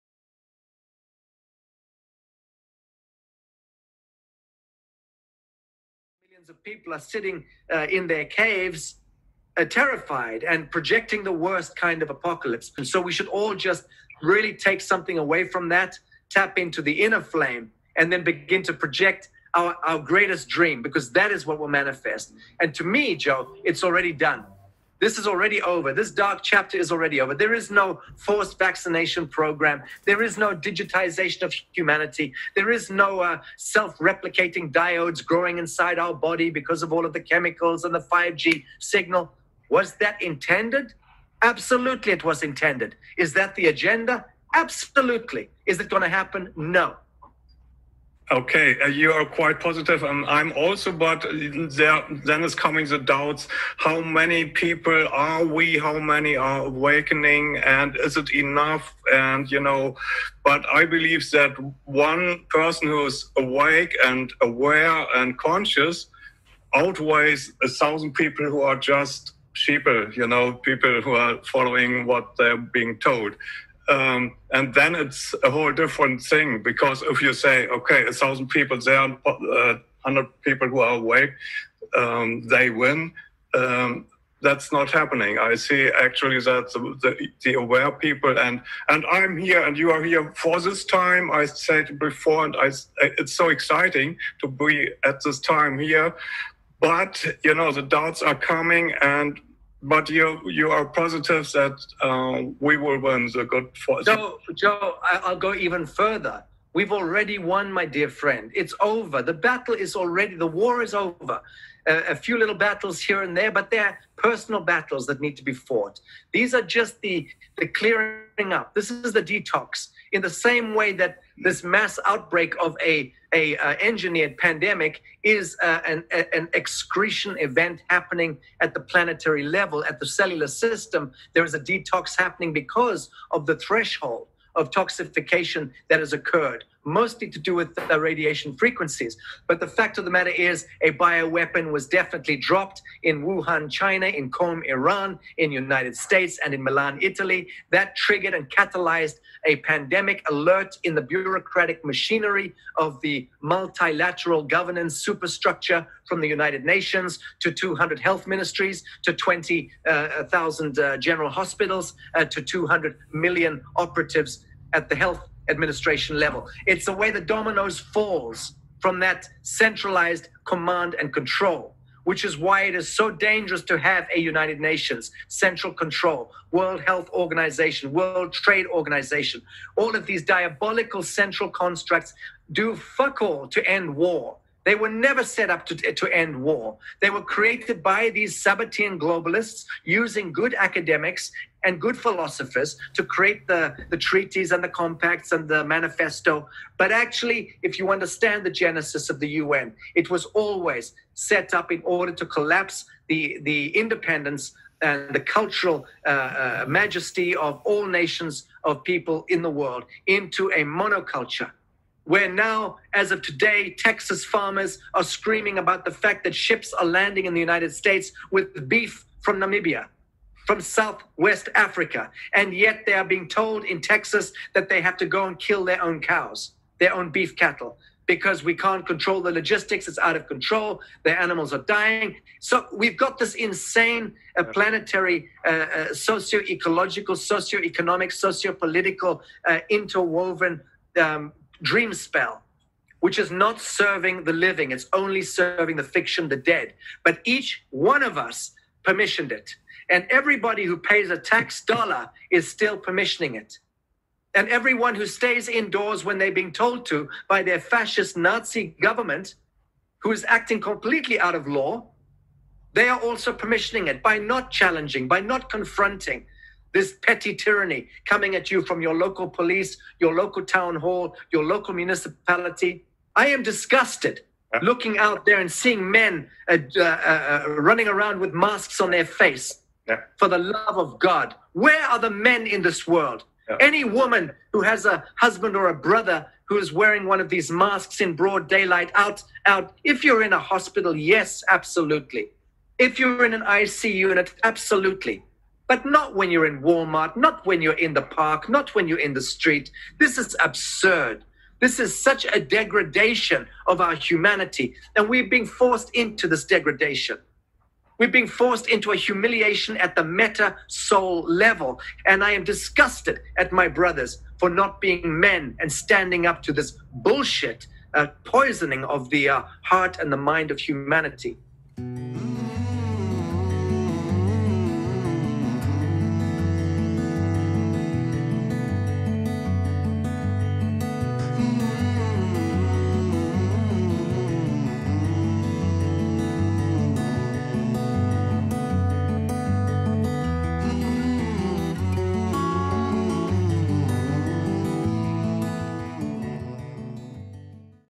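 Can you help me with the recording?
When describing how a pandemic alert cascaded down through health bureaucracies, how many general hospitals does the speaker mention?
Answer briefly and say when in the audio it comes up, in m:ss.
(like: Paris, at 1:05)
20,000, at 2:39.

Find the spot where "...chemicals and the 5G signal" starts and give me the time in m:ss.
0:37.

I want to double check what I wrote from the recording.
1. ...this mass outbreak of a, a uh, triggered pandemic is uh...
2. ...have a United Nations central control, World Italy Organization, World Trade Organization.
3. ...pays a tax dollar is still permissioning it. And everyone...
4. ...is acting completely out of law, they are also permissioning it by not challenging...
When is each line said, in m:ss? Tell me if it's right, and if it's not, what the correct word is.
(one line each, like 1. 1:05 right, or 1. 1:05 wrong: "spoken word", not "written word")
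1. 2:01 wrong: "engineered", not "triggered"
2. 2:53 wrong: "Health", not "Italy"
3. 4:10 right
4. 4:20 right.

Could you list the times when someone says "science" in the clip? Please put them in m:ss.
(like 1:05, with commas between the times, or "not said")
not said.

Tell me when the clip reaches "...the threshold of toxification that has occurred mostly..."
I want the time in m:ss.
2:13.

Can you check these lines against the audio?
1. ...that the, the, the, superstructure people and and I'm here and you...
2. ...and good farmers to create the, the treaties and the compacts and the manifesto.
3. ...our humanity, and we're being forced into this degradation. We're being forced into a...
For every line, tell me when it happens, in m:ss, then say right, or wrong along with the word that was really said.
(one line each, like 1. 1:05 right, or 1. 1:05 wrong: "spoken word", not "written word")
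1. 1:26 wrong: "aware", not "superstructure"
2. 3:11 wrong: "philosophers", not "farmers"
3. 5:03 right.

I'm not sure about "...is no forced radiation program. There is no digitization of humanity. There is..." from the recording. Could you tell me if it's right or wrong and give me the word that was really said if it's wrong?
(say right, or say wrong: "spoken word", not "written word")
wrong: "vaccination", not "radiation".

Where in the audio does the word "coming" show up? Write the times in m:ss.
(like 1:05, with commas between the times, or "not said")
0:52, 1:38, 4:28.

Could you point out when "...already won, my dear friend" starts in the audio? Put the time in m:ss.
1:46.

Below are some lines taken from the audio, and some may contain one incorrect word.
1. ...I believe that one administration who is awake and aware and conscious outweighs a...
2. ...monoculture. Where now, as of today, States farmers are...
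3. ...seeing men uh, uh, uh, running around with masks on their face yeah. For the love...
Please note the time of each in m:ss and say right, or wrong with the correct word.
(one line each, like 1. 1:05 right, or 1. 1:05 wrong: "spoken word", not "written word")
1. 1:00 wrong: "person", not "administration"
2. 3:30 wrong: "Texas", not "States"
3. 4:35 right.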